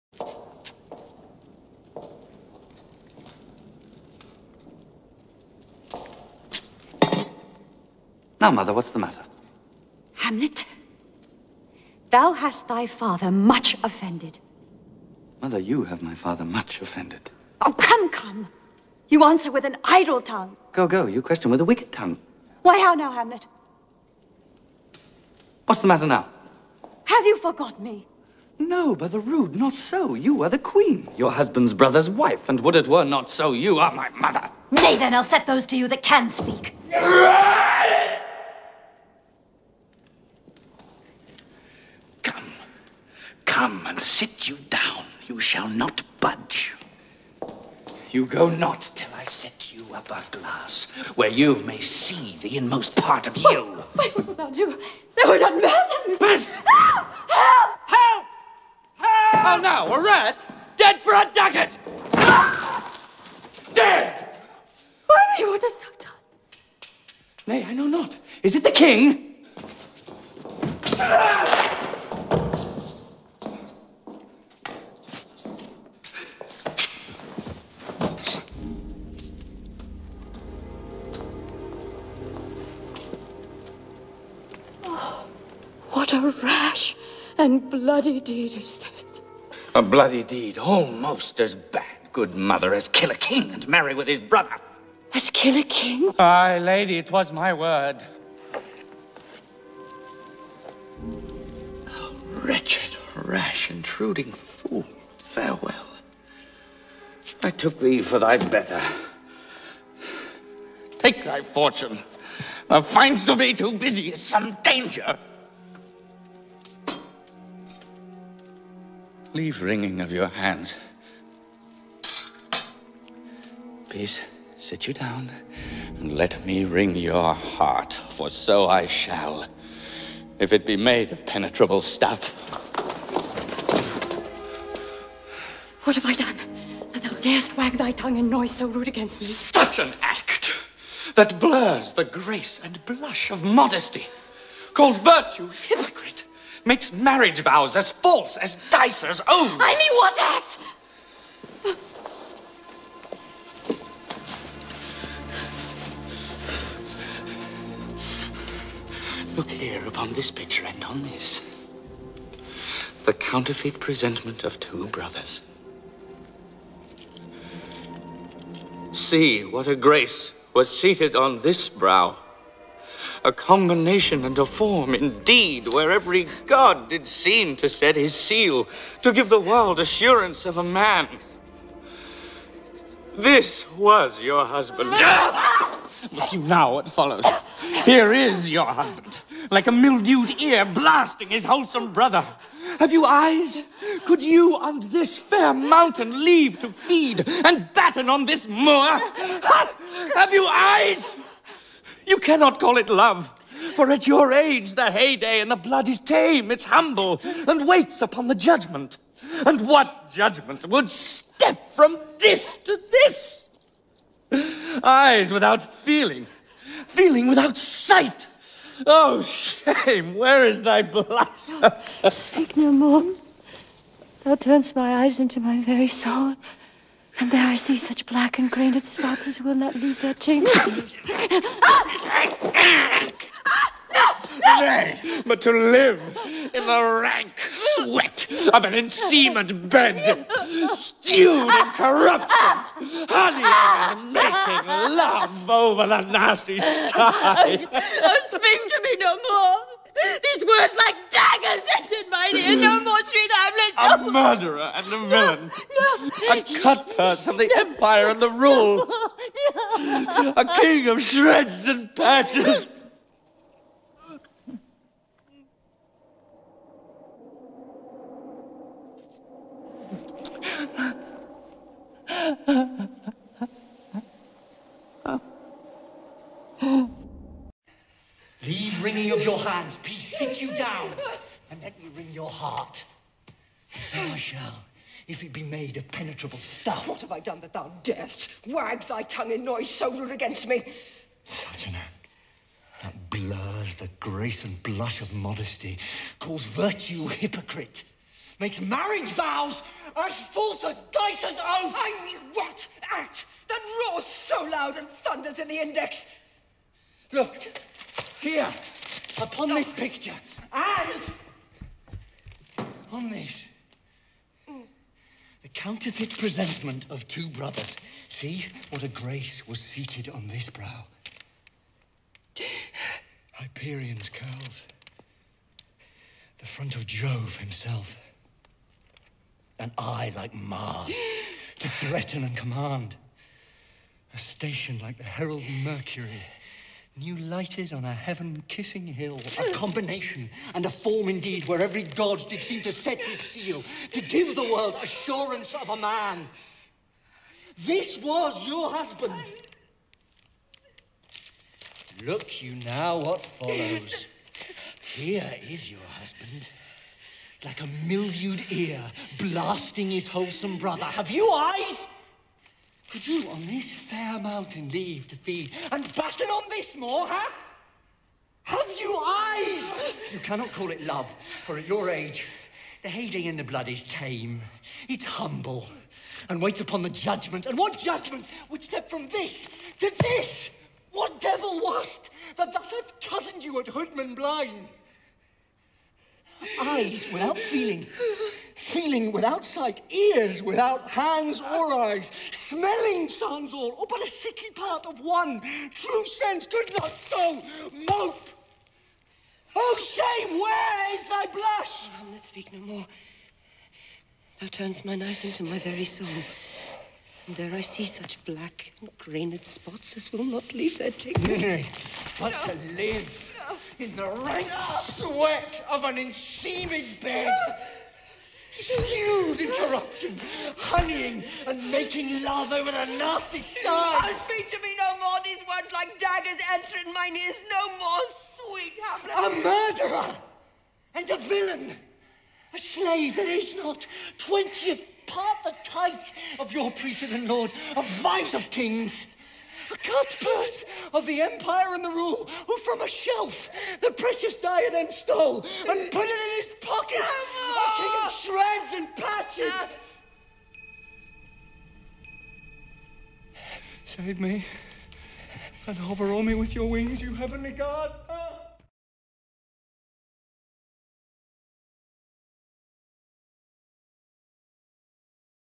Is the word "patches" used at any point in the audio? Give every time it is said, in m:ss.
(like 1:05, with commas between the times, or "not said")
4:21, 7:28.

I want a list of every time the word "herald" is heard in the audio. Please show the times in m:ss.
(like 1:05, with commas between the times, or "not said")
5:35.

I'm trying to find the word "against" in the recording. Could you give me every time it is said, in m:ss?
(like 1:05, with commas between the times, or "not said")
2:18, 4:50.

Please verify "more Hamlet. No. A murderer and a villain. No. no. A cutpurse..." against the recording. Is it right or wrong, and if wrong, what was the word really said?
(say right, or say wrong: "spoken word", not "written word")
right.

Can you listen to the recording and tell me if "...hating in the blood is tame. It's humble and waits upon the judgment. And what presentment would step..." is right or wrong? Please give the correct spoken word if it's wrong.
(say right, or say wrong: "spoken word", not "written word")
wrong: "judgment", not "presentment".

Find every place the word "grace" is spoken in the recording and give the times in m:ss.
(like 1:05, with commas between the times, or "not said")
2:22, 2:49, 4:53, 5:18.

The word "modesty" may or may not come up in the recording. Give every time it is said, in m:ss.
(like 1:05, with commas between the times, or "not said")
2:23, 4:55.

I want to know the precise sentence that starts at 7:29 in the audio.
Uh, Save me and hover o'er me with your wings, you heavenly god.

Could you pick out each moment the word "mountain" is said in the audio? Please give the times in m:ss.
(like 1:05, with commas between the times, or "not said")
3:15, 6:04.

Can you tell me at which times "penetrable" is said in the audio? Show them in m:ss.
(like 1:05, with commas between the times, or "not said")
2:11, 4:45.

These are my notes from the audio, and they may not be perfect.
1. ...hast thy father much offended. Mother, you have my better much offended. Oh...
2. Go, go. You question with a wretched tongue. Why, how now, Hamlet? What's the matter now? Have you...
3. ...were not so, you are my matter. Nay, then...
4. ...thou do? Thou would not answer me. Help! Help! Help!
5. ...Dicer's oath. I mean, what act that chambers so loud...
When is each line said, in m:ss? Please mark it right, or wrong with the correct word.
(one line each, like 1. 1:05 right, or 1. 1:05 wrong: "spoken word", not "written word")
1. 0:12 wrong: "father", not "better"
2. 0:20 wrong: "wicked", not "wretched"
3. 0:32 wrong: "mother", not "matter"
4. 0:54 wrong: "murder", not "answer"
5. 5:00 wrong: "roars", not "chambers".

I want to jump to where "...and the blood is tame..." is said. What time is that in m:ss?
3:25.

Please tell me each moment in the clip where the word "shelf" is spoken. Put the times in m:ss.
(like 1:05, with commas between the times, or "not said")
7:22.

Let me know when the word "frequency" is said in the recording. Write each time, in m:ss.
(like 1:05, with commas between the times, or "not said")
not said.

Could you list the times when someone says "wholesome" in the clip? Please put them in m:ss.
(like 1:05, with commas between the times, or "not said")
3:11, 6:00.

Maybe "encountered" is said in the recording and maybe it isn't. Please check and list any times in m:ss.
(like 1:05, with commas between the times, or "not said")
not said.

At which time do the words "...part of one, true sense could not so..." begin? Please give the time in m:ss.
6:34.